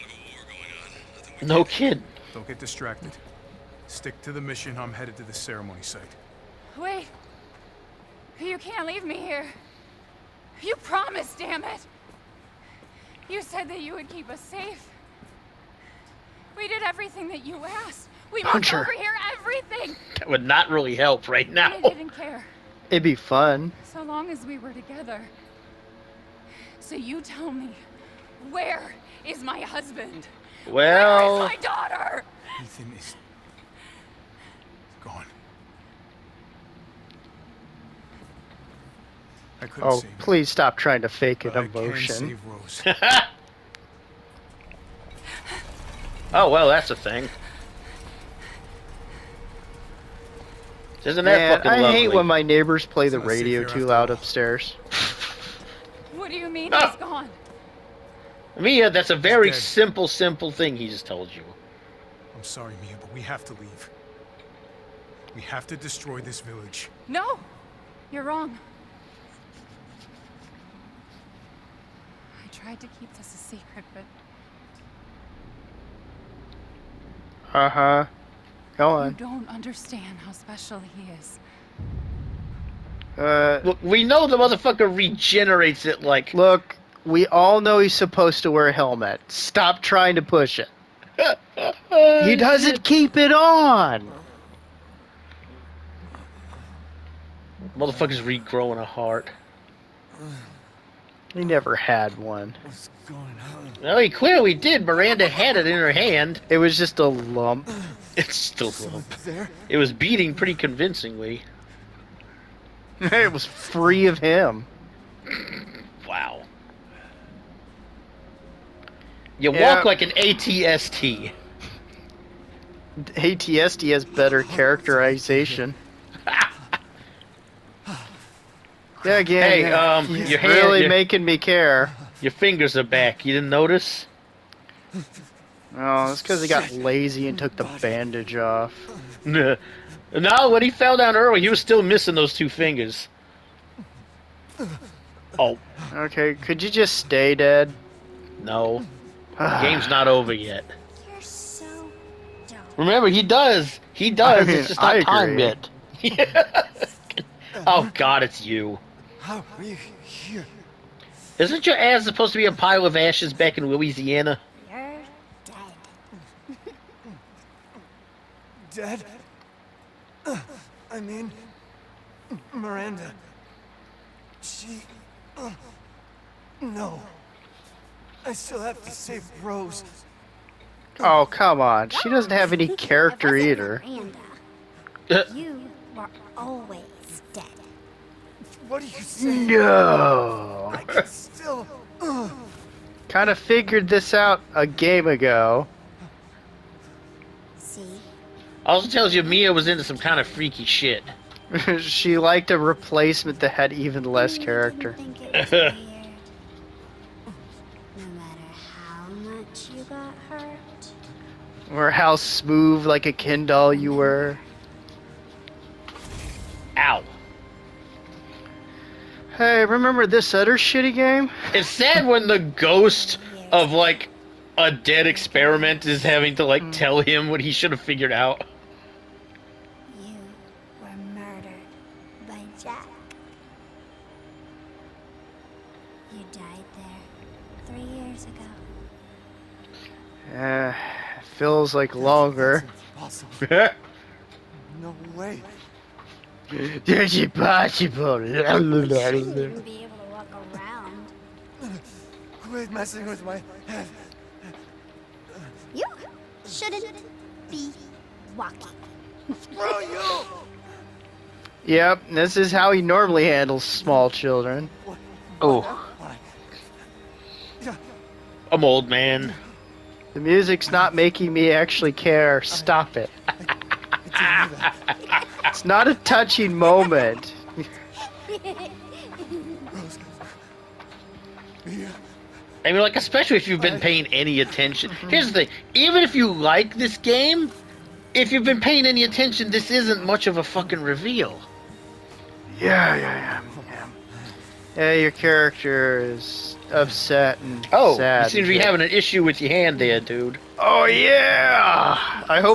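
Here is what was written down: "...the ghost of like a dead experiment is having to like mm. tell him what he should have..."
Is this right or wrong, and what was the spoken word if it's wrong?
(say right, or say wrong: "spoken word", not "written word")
right.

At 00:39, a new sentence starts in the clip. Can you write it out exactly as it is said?
I couldn't oh, please stop trying to fake an emotion.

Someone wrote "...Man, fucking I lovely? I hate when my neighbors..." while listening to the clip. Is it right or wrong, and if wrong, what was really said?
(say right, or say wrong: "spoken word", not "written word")
right.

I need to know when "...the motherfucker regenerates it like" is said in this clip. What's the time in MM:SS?
01:24.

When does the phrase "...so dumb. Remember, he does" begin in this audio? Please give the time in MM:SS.
02:31.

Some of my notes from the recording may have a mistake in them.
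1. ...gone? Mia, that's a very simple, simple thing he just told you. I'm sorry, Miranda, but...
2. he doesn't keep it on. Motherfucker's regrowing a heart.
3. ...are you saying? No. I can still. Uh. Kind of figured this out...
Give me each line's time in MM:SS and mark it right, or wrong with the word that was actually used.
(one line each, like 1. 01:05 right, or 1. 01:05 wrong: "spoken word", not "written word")
1. 00:56 wrong: "Mia", not "Miranda"
2. 01:32 right
3. 03:08 right.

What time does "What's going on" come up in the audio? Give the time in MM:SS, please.
01:42.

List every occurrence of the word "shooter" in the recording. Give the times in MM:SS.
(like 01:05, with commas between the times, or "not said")
not said.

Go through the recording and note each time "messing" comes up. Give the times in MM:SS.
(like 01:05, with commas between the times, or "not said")
04:12.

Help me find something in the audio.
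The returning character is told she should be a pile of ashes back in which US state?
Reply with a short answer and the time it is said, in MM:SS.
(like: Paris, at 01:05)
Louisiana, at 02:43.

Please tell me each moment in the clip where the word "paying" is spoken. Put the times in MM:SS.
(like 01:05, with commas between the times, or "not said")
04:43, 04:48.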